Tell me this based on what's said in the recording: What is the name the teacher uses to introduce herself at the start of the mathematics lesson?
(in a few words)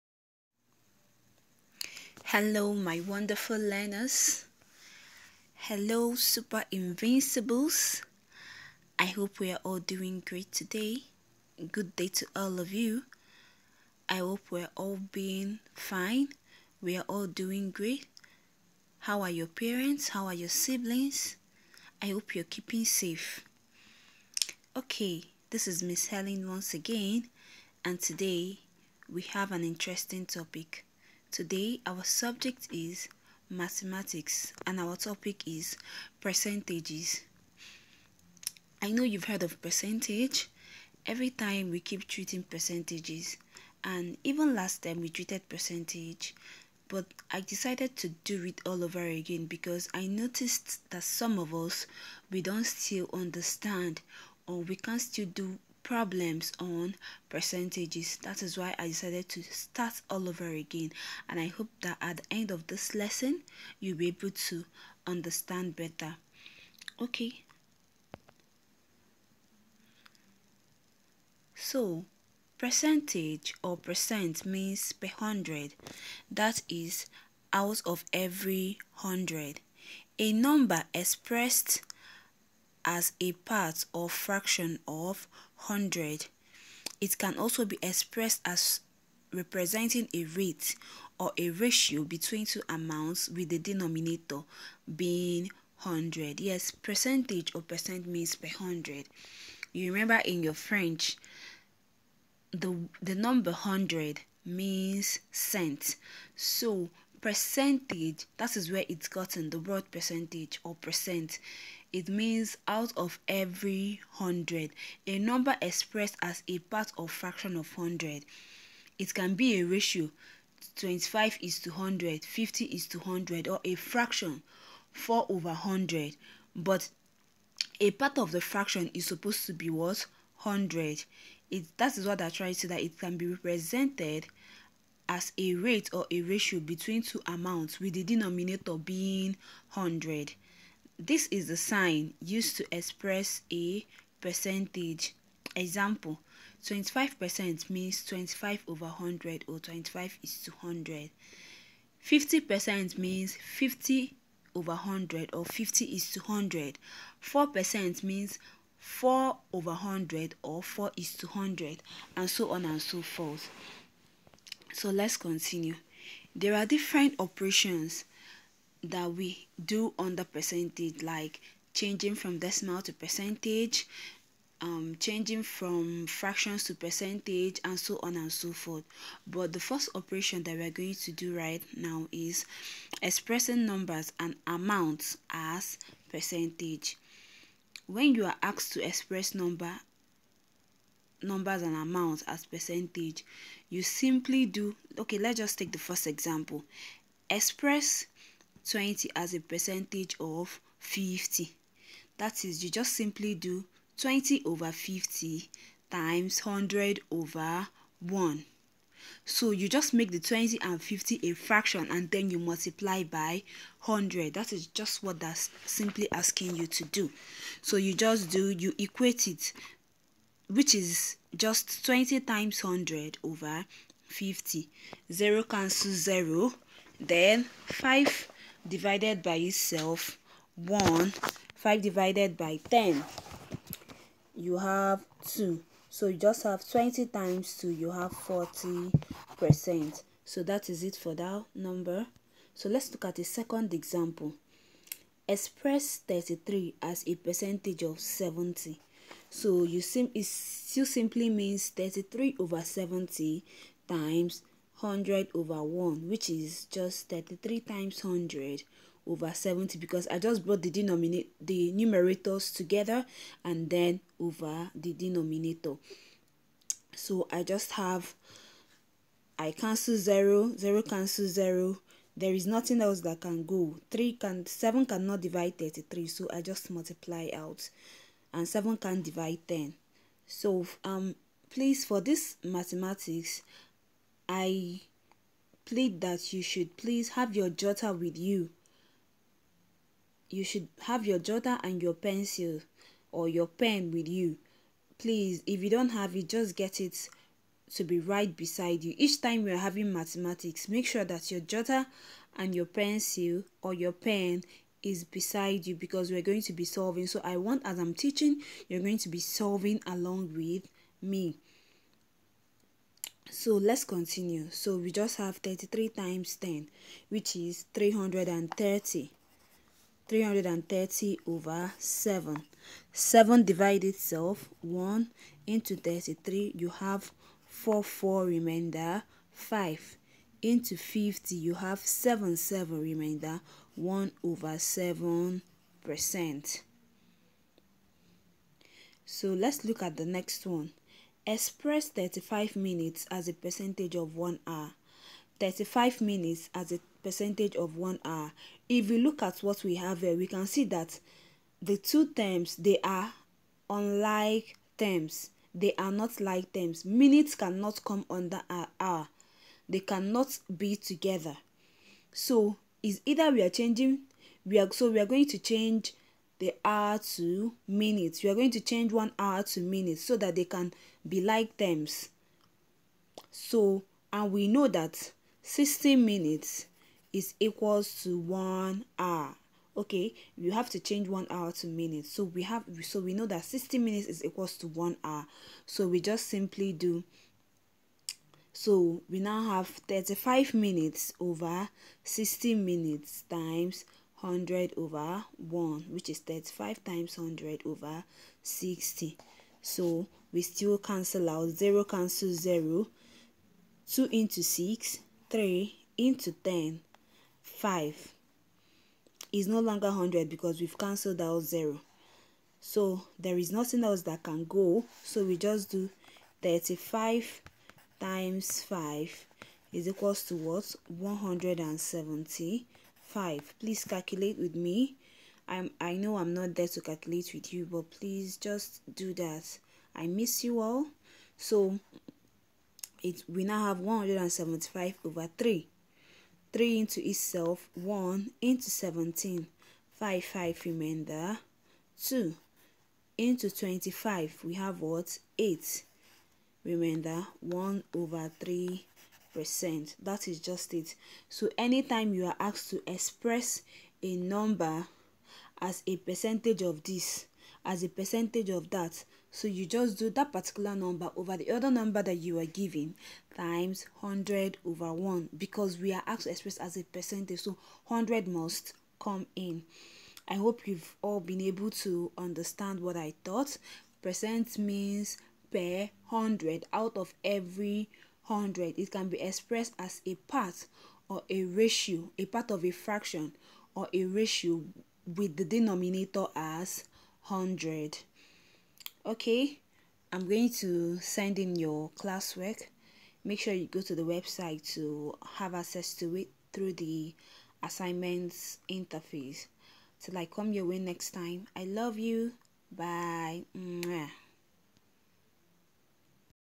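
Miss Helen.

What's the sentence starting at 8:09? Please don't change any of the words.
Okay, I'm going to send in your classwork.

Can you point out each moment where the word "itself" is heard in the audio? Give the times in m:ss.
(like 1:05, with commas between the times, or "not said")
3:49, 5:23, 7:17.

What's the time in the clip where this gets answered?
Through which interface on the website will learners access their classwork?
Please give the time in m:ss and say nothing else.
8:17.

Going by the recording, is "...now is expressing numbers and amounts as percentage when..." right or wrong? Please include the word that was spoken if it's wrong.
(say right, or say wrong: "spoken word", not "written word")
right.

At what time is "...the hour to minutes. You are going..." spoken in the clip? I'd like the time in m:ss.
6:06.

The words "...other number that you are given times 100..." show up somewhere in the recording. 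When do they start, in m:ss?
7:41.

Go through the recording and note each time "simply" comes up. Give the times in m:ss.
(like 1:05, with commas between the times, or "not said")
3:13, 3:22, 3:35, 4:10, 6:26.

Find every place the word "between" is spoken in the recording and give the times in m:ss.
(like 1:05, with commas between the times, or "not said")
1:32, 2:16.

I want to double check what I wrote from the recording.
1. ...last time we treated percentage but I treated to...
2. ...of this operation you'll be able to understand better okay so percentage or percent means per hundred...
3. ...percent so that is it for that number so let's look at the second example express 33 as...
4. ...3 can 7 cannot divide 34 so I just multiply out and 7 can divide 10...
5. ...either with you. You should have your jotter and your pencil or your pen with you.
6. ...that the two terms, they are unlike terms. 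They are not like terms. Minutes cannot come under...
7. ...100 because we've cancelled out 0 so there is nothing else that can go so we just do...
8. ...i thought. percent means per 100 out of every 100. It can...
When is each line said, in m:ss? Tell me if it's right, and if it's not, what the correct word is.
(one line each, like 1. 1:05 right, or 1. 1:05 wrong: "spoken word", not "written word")
1. 0:44 wrong: "decided", not "treated"
2. 1:02 wrong: "lesson", not "operation"
3. 3:59 right
4. 4:33 wrong: "33", not "34"
5. 4:47 wrong: "jotter", not "either"
6. 5:50 right
7. 6:49 right
8. 7:52 right.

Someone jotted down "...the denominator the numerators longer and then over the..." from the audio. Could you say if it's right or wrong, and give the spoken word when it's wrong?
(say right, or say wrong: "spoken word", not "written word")
wrong: "together", not "longer".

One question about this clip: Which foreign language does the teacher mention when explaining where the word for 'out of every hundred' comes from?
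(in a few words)
French.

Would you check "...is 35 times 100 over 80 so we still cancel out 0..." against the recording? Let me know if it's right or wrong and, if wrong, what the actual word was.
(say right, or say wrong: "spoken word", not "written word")
wrong: "60", not "80".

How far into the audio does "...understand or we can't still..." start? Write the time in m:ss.
0:53.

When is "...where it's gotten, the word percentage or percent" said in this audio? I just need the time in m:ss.
1:48.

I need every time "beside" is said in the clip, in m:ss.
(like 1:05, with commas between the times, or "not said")
4:58, 5:05.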